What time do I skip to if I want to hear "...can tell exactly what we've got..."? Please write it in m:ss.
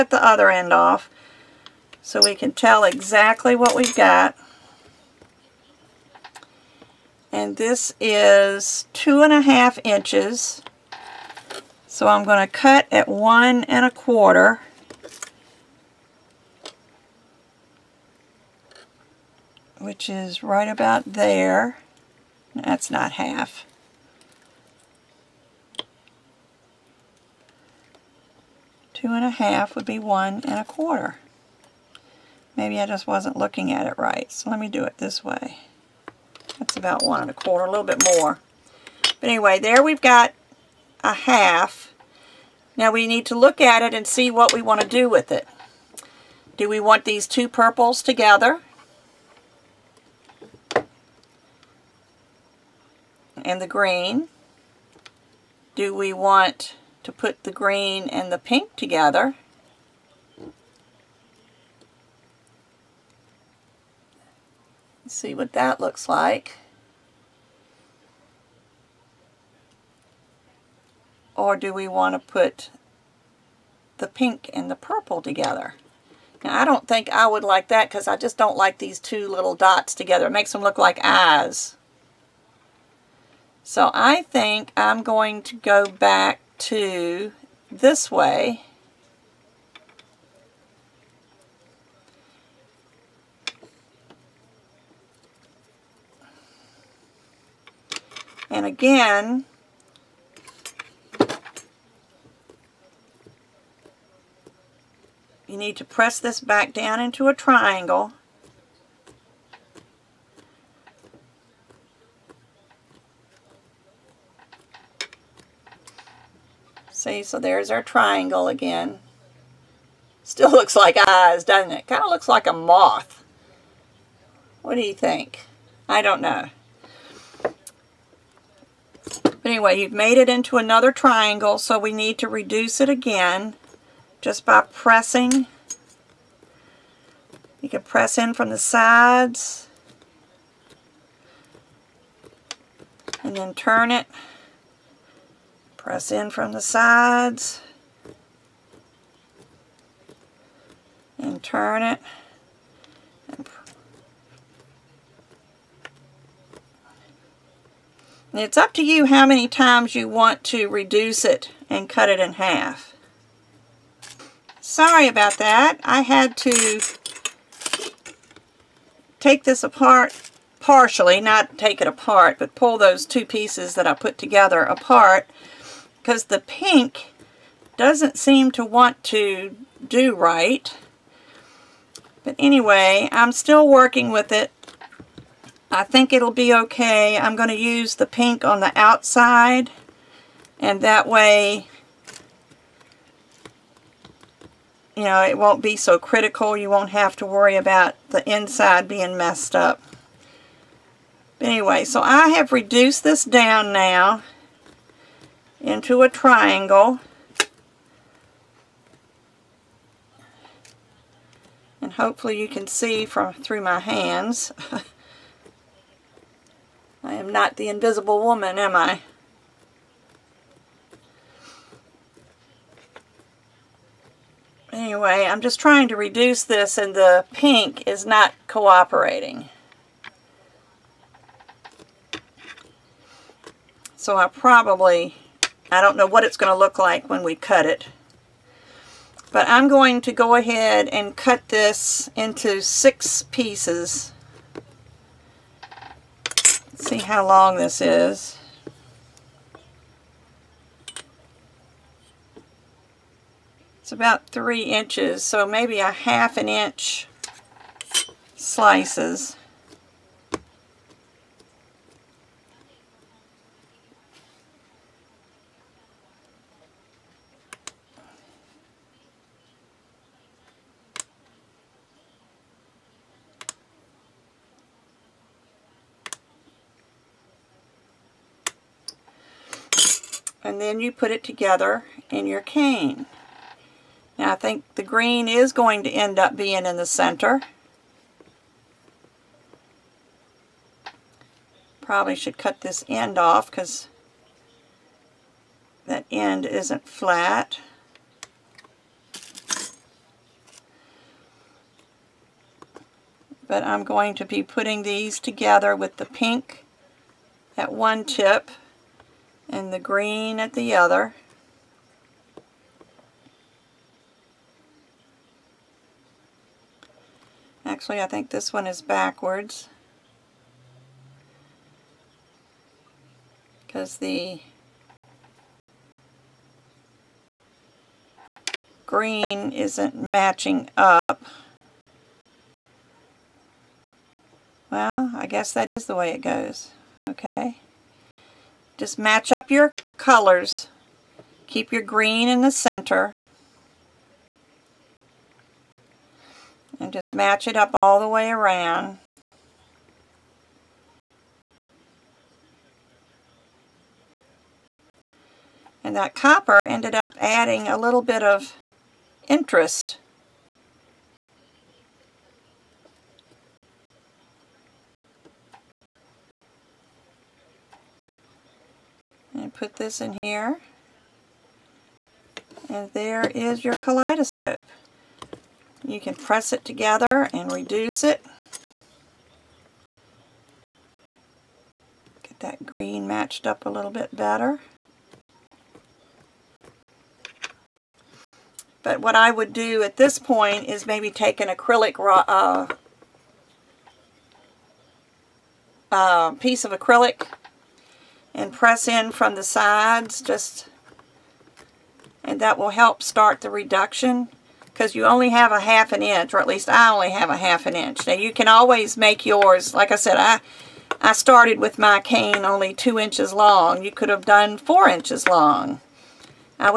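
0:02.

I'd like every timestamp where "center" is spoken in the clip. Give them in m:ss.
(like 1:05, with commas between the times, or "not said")
4:46, 5:42.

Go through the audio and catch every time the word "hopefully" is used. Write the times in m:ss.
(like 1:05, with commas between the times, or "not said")
3:31.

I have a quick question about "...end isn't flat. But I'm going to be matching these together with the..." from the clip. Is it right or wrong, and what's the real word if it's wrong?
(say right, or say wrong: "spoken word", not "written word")
wrong: "putting", not "matching".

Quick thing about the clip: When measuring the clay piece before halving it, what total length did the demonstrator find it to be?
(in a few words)
2 1/2 inches.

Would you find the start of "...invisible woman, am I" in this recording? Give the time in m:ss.
3:37.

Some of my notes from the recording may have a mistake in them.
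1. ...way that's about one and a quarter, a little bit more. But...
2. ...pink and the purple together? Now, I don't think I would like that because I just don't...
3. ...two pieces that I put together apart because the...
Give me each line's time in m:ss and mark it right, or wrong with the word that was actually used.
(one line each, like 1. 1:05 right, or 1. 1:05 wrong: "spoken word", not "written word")
1. 0:35 right
2. 1:14 right
3. 2:53 right.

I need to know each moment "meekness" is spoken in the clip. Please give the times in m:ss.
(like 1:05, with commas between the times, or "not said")
not said.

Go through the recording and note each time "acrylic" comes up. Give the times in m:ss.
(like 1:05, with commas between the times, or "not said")
6:31, 6:36.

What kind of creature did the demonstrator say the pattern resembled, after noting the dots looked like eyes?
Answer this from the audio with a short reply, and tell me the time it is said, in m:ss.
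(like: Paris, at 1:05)
moth, at 2:02.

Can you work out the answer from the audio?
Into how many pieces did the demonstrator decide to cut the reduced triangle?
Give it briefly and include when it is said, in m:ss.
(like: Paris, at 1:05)
6, at 4:02.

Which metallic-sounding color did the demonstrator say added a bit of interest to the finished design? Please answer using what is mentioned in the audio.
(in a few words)
copper.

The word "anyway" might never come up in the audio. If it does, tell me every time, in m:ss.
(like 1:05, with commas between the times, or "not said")
0:39, 2:09, 3:02, 3:21, 3:44.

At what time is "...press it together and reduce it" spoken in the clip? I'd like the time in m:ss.
6:16.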